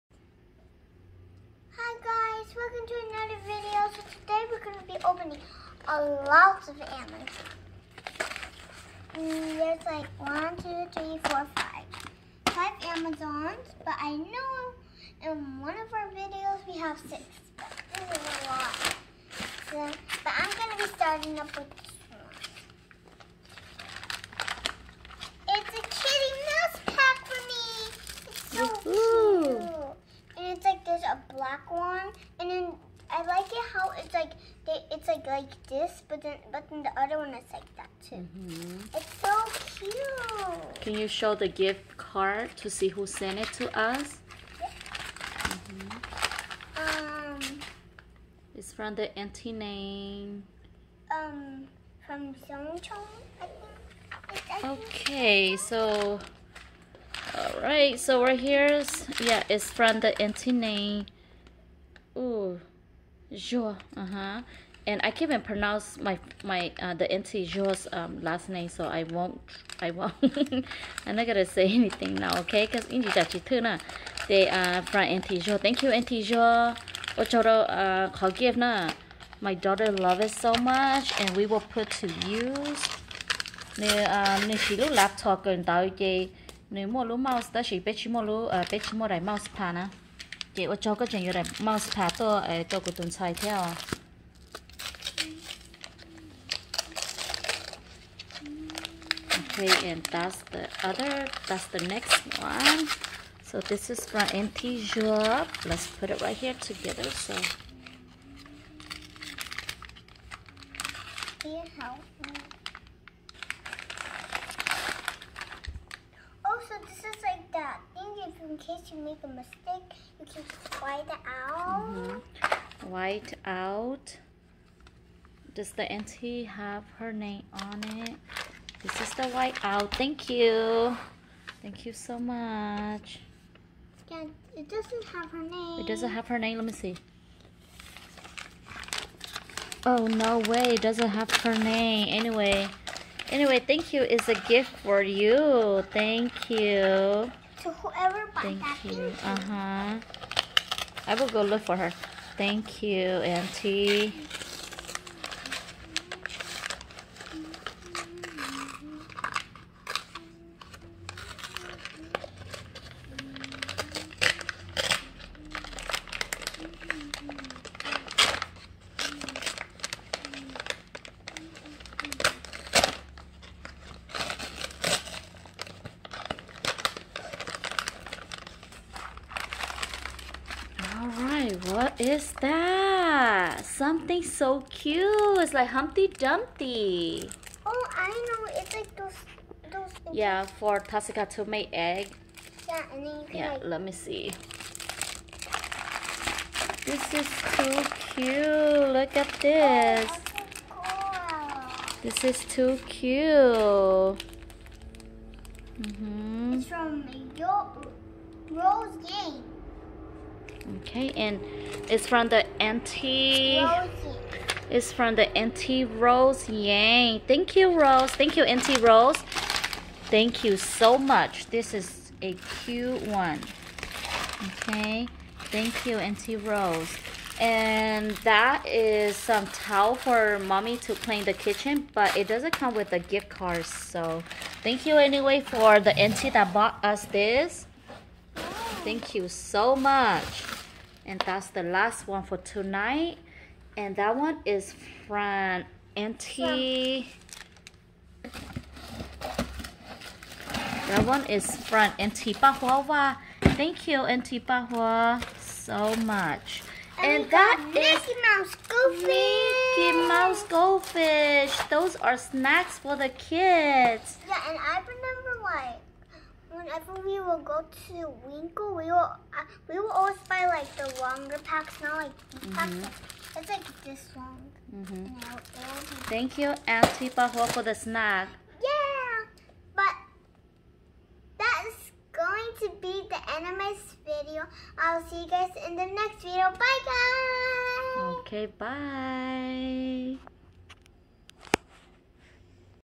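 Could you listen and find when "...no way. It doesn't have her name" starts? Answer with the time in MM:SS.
02:20.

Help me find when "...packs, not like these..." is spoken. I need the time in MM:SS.
04:31.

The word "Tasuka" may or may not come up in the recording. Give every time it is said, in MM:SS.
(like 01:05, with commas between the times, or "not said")
03:10.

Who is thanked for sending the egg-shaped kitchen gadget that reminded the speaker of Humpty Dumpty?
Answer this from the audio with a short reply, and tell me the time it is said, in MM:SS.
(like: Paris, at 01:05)
Auntie Rose Yang, at 03:35.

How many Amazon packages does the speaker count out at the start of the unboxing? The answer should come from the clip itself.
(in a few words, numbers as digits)
5.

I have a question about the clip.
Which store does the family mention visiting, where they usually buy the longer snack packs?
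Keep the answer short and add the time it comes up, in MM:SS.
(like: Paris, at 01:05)
Winkle, at 04:28.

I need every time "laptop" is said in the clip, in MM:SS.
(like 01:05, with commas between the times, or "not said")
01:24.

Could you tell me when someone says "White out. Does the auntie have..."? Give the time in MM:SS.
02:02.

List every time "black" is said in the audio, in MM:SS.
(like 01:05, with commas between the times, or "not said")
00:31.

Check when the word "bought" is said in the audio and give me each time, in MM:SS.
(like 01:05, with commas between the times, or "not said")
02:28, 03:56.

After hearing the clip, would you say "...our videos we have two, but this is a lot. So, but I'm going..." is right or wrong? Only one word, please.
wrong.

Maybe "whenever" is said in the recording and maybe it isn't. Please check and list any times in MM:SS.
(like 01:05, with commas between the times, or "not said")
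04:26.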